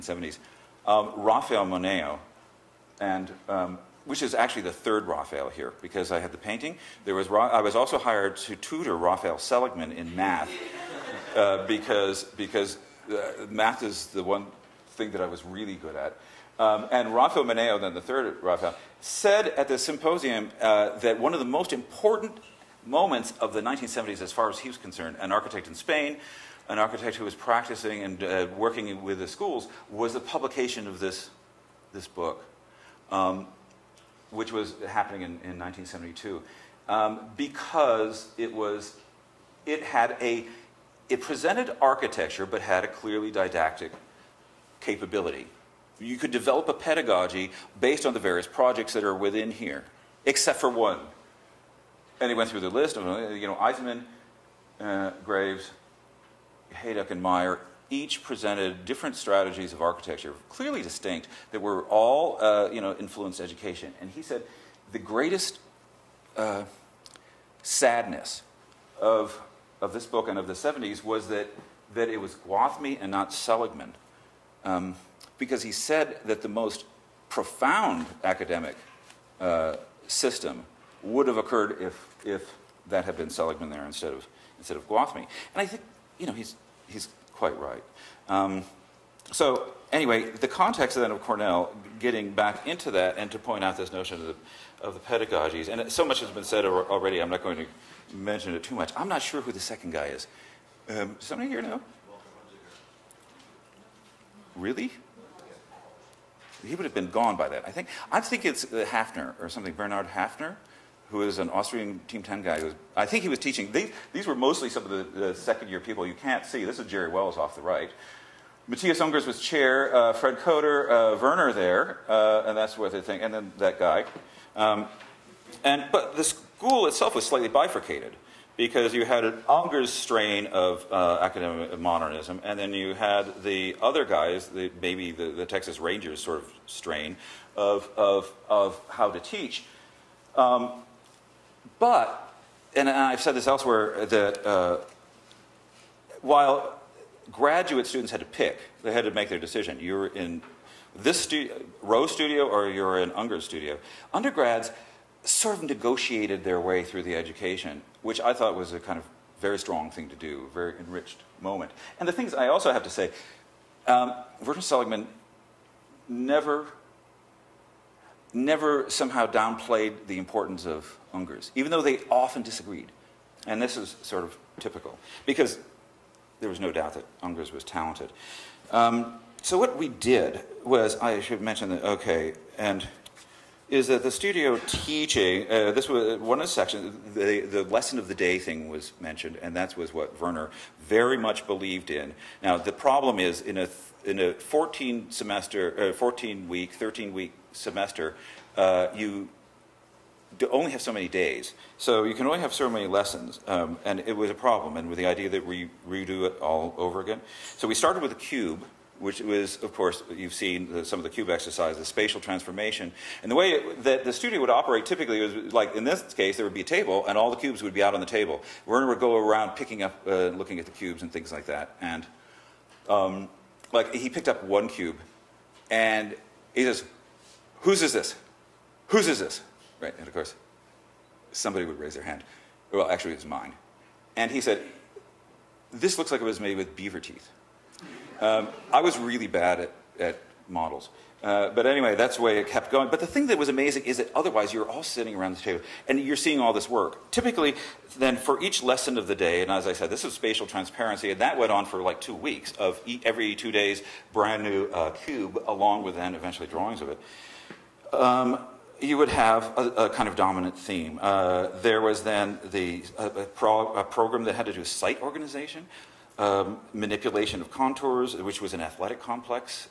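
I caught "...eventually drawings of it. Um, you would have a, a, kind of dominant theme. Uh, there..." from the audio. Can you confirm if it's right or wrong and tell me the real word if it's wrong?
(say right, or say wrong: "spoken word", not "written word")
right.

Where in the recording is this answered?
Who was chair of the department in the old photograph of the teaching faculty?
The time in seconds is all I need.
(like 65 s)
118 s.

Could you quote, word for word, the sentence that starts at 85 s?
And I think, you know, he's, he's quite right.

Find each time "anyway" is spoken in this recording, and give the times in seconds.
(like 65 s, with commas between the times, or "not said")
89 s, 241 s.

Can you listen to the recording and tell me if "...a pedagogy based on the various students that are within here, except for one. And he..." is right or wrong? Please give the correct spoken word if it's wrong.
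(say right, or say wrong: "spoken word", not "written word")
wrong: "projects", not "students".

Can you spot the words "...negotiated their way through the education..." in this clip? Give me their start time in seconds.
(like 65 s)
155 s.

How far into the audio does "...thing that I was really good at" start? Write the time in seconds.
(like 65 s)
14 s.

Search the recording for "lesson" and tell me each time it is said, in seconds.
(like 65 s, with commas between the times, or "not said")
187 s, 202 s, 248 s.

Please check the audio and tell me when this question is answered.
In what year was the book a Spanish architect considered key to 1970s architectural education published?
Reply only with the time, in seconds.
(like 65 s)
35 s.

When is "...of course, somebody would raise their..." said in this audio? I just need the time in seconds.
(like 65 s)
230 s.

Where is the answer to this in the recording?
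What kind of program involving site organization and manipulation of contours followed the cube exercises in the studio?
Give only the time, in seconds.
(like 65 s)
268 s.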